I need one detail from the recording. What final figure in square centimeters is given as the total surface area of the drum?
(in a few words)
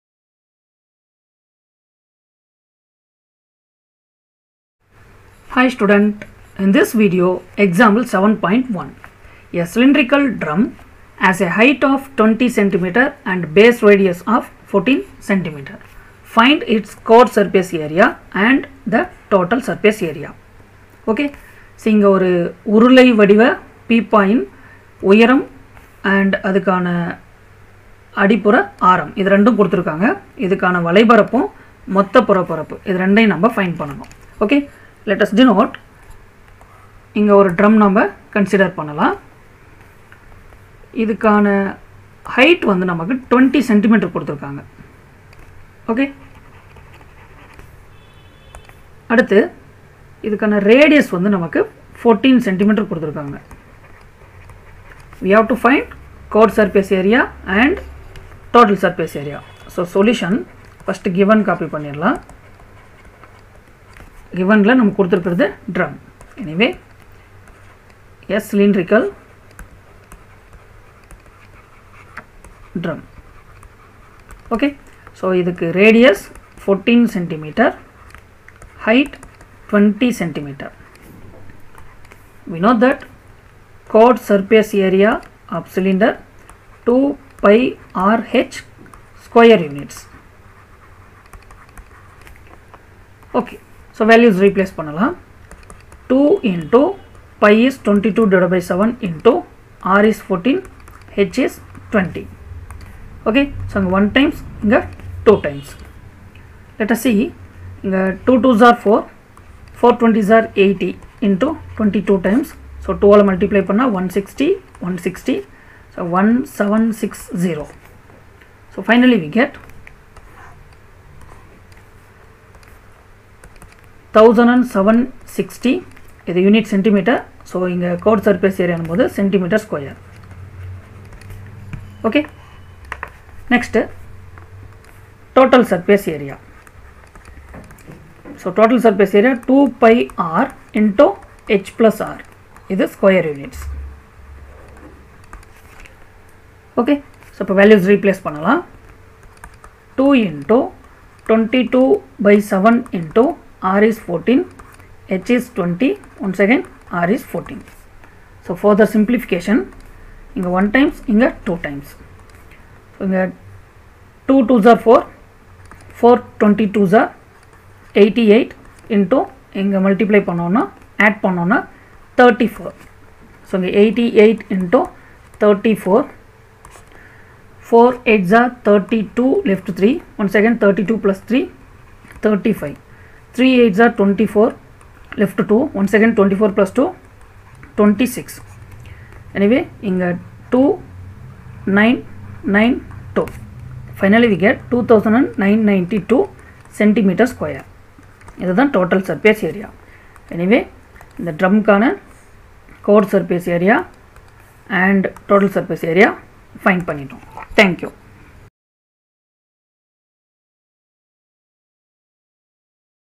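2992.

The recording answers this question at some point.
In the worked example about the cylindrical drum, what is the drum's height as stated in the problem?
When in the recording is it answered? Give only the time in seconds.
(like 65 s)
11 s.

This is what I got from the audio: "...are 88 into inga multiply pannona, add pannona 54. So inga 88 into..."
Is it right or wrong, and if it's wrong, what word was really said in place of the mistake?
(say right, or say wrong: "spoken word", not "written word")
wrong: "34", not "54".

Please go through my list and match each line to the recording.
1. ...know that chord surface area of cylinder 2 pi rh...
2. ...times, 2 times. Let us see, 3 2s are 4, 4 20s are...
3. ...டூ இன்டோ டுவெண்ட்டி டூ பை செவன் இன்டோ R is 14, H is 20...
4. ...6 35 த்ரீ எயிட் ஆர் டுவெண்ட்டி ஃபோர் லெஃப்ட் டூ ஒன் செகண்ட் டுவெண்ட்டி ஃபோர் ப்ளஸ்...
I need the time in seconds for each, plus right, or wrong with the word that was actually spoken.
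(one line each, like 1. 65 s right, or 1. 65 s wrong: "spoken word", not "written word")
1. 82 s right
2. 104 s wrong: "2", not "3"
3. 149 s right
4. 181 s wrong: "3", not "6".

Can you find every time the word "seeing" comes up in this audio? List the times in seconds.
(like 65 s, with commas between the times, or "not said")
21 s.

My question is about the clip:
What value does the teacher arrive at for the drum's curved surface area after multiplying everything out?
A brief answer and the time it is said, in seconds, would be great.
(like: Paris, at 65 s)
1760, at 116 s.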